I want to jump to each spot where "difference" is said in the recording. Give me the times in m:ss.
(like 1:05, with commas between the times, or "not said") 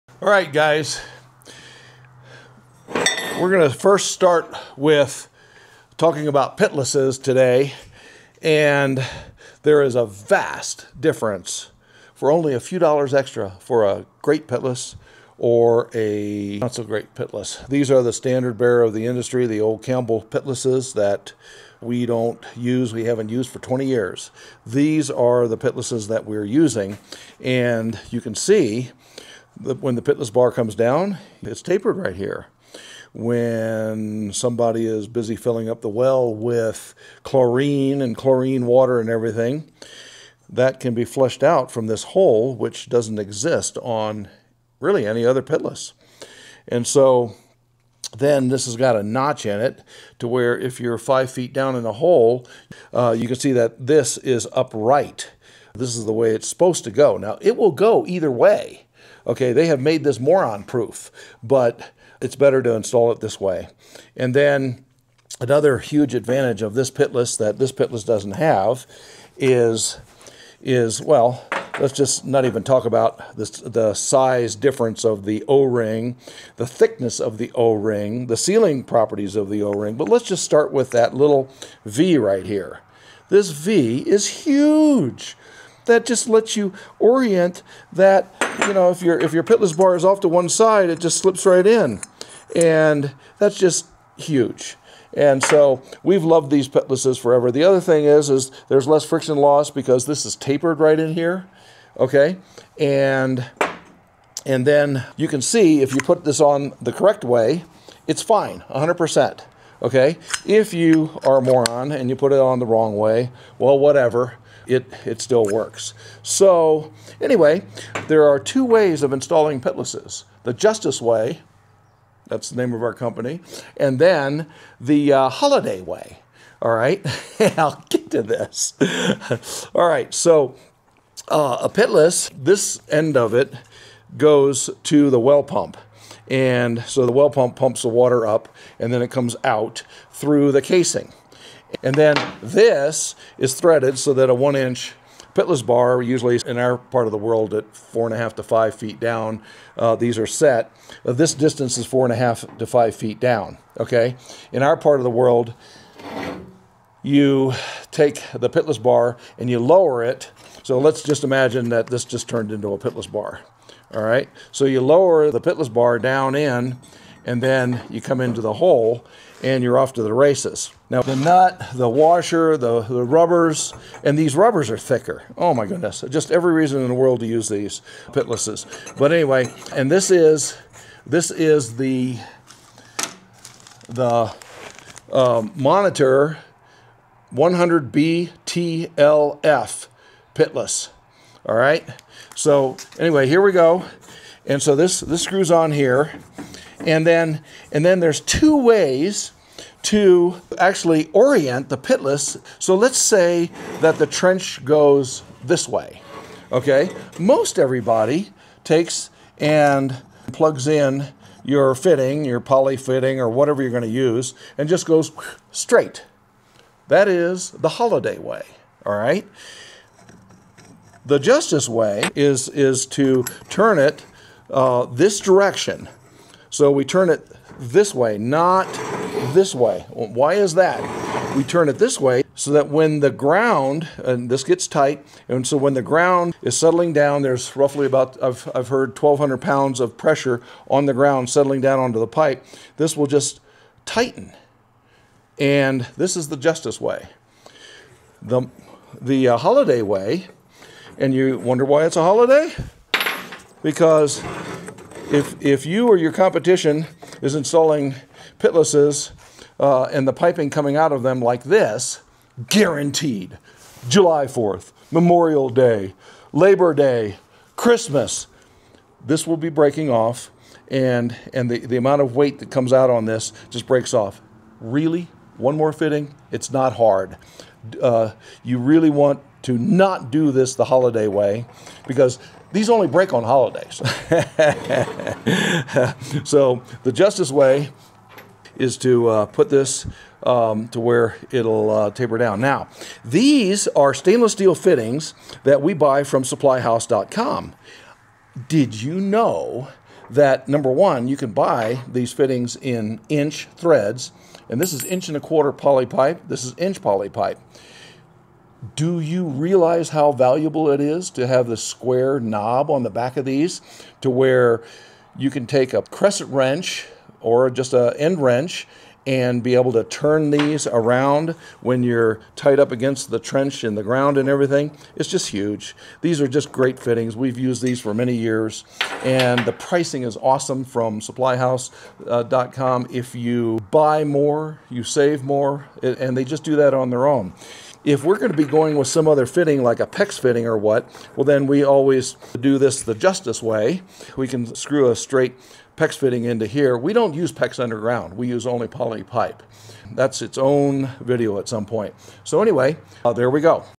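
0:11, 1:14.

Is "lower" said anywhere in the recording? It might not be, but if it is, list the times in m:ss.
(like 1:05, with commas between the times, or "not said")
2:39, 2:44.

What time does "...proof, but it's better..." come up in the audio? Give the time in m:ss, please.
1:00.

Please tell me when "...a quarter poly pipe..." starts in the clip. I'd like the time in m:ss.
5:05.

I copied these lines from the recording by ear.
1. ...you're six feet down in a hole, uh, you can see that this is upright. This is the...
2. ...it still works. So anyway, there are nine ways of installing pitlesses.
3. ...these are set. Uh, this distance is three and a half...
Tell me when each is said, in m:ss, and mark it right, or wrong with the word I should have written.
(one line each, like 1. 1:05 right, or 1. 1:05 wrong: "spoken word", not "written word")
1. 0:50 wrong: "five", not "six"
2. 1:55 wrong: "two", not "nine"
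3. 2:29 wrong: "four", not "three".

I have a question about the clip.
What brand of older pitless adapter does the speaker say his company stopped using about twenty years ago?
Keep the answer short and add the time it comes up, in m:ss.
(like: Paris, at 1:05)
Campbell, at 0:19.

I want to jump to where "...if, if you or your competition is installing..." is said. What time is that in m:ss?
4:15.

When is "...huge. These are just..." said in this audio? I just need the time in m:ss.
5:25.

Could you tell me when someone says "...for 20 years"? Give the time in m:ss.
0:23.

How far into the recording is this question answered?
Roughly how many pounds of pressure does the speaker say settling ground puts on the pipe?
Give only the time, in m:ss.
3:58.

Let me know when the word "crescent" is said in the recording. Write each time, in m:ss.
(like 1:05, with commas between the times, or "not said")
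5:15.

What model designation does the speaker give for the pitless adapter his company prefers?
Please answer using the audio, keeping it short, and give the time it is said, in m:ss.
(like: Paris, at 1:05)
Monitor 100BTLF, at 3:05.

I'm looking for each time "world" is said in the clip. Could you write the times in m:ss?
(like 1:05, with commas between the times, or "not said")
2:27, 2:35, 2:56.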